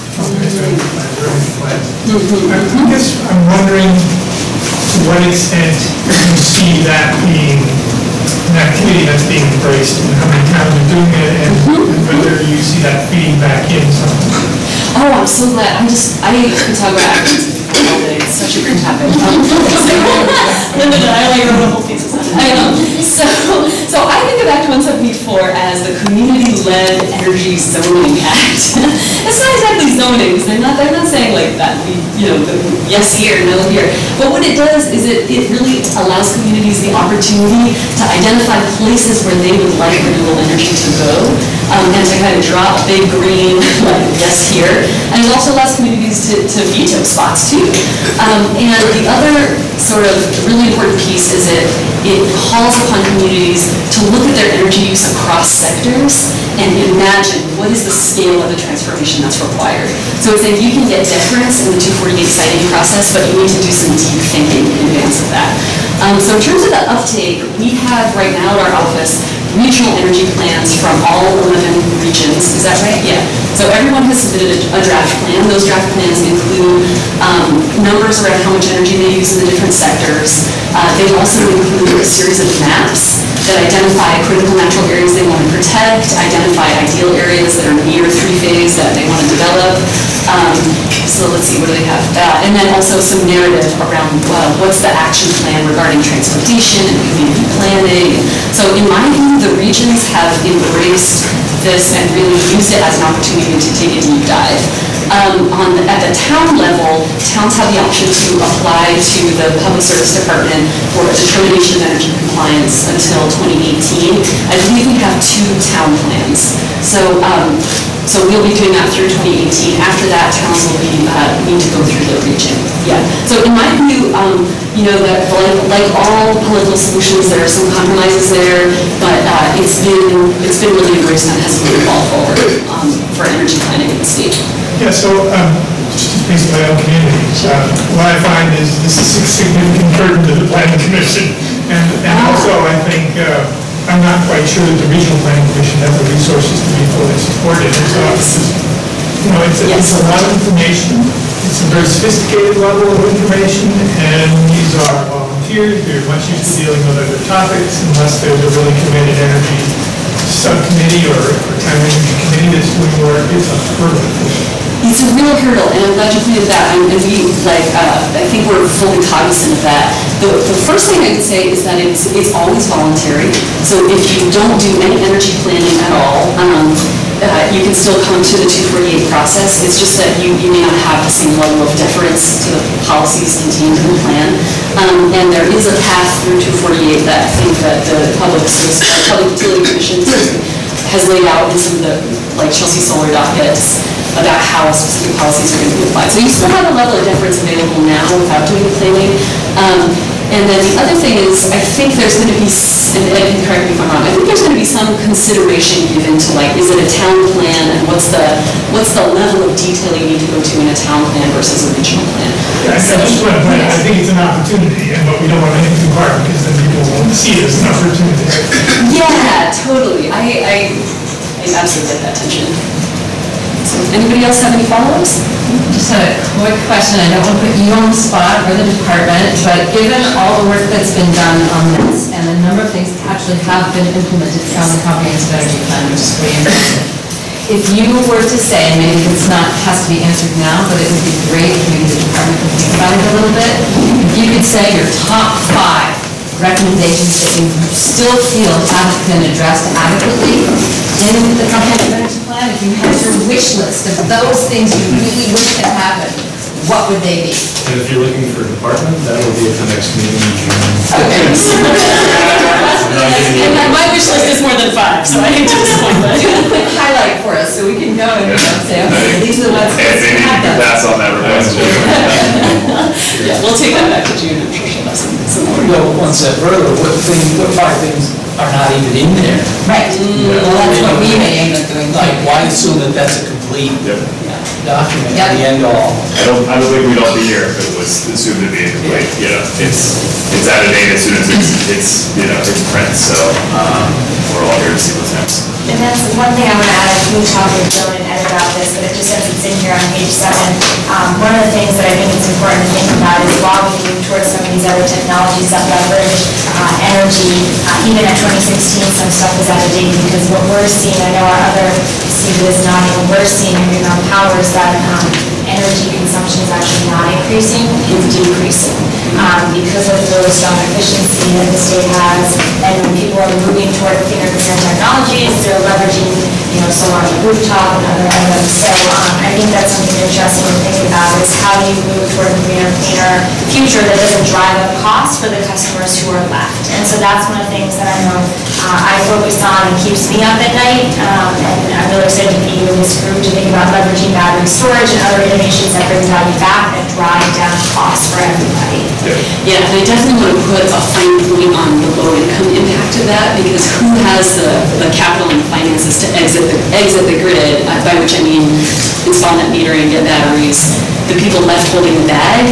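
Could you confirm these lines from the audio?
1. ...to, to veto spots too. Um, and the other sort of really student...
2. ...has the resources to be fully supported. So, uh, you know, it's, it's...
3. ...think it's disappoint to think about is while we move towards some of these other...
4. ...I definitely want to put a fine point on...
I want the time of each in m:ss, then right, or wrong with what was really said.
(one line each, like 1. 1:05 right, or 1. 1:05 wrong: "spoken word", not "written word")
1. 0:46 wrong: "important", not "student"
2. 2:25 right
3. 5:01 wrong: "important", not "disappoint"
4. 5:49 right.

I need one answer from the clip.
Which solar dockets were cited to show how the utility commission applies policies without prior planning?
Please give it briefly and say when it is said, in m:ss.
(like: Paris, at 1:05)
Chelsea Solar, at 3:12.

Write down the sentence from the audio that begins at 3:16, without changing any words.
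So you still have a level of deference available now without doing the planning.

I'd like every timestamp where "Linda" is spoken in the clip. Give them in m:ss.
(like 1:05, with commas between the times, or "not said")
0:20.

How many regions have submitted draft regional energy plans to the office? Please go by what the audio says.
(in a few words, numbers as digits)
11.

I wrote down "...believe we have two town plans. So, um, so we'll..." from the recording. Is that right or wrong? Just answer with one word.
right.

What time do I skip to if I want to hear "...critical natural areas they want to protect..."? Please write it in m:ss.
1:24.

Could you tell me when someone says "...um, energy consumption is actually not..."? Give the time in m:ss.
5:14.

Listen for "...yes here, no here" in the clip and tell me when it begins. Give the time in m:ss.
0:32.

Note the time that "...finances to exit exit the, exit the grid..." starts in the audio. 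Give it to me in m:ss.
5:55.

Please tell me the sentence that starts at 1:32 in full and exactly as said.
Uh, and then also some narrative around uh, what's the action plan regarding transportation and community planning.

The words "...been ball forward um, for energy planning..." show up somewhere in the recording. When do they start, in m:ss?
2:11.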